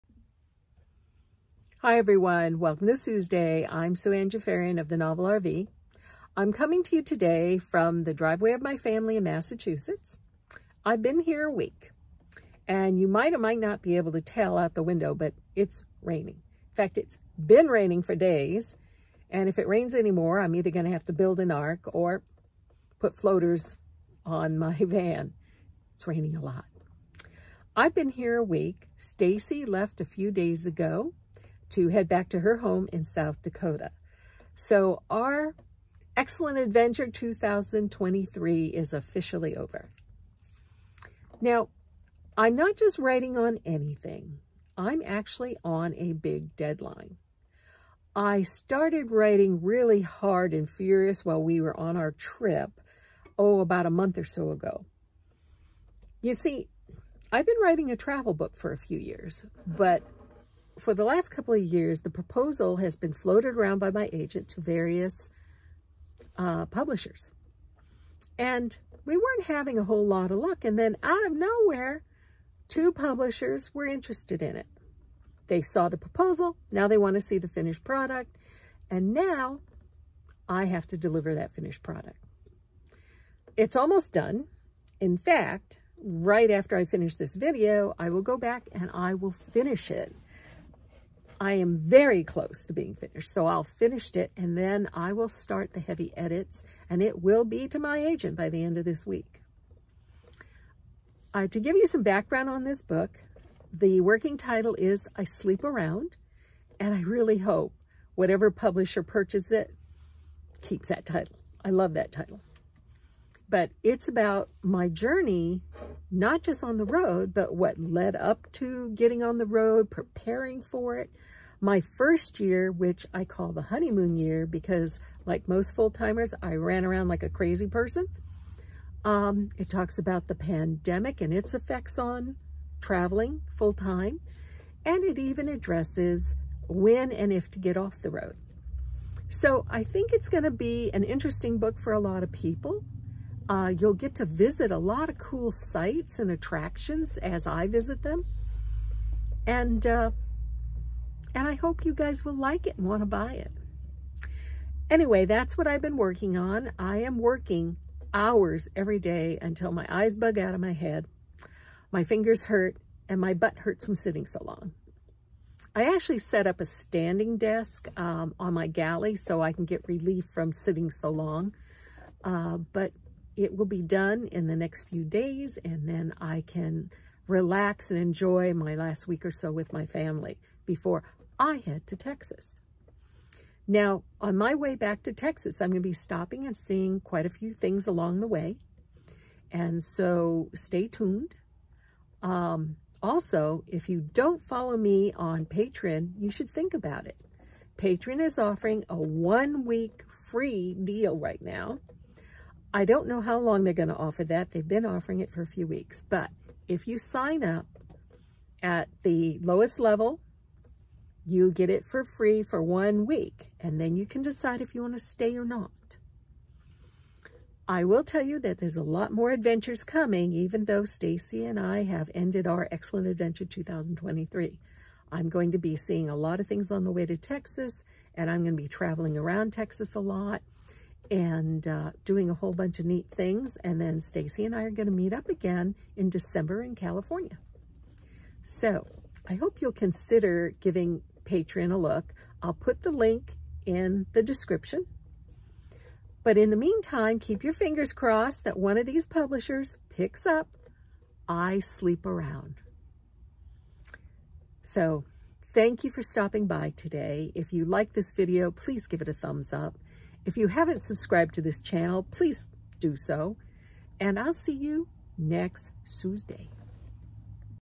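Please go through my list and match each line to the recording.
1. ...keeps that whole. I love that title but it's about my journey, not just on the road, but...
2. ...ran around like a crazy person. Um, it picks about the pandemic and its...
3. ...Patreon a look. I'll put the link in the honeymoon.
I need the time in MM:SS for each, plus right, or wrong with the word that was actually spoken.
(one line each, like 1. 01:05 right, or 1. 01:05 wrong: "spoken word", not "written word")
1. 01:50 wrong: "title", not "whole"
2. 02:06 wrong: "talks", not "picks"
3. 04:01 wrong: "description", not "honeymoon".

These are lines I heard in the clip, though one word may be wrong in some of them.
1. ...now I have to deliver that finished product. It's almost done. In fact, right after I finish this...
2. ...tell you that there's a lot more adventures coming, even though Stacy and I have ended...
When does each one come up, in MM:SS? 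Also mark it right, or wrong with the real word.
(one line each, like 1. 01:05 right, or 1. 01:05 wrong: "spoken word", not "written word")
1. 01:19 right
2. 03:38 right.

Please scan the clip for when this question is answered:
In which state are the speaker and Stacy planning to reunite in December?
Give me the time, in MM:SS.
03:56.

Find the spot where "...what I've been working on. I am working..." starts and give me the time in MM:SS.
02:35.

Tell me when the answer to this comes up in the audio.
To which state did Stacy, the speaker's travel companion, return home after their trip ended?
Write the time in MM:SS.
00:33.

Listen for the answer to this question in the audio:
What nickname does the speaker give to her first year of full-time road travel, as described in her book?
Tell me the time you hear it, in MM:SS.
02:03.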